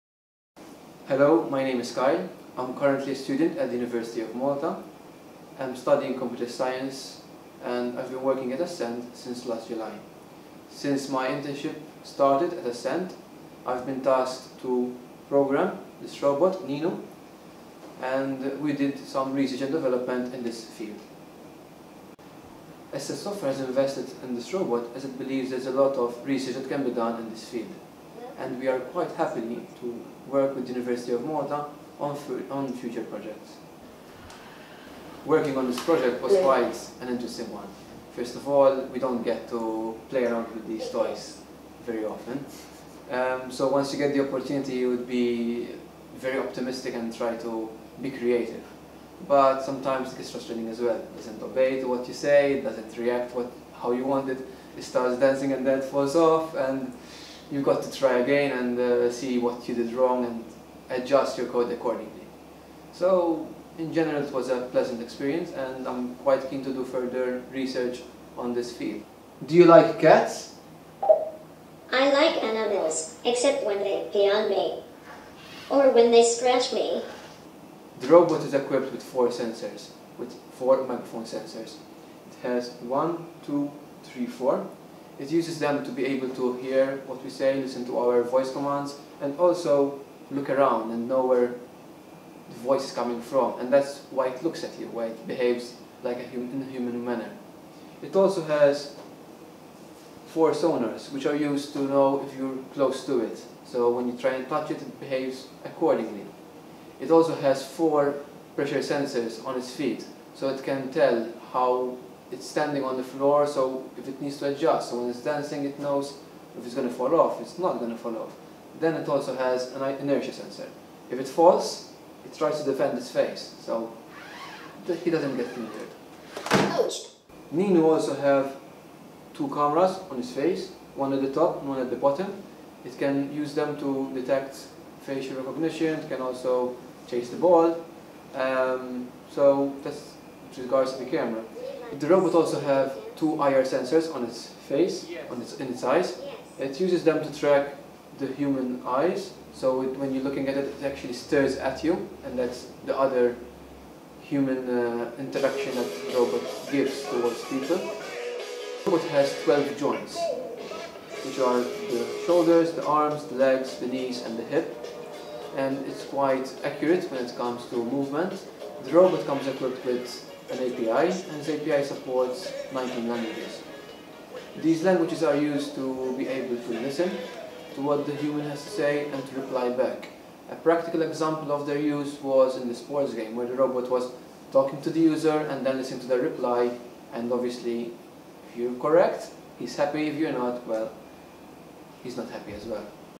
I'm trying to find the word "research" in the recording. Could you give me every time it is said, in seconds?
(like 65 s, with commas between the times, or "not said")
19 s, 26 s, 67 s.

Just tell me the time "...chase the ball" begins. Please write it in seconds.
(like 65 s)
137 s.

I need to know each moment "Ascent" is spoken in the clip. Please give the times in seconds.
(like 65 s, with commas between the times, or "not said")
8 s, 12 s, 22 s.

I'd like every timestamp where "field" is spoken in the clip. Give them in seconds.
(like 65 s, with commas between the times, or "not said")
20 s, 27 s, 68 s.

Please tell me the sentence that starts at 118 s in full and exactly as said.
Then it also has an inertia sensor.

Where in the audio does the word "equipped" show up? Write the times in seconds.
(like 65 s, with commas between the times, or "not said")
78 s, 169 s.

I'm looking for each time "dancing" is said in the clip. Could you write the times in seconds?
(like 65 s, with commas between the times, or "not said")
55 s, 115 s.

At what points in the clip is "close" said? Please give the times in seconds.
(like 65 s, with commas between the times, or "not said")
102 s.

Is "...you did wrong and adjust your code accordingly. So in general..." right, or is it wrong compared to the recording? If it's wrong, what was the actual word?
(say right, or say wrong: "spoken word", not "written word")
right.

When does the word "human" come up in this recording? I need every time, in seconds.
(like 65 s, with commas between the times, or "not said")
96 s, 148 s, 154 s, 178 s.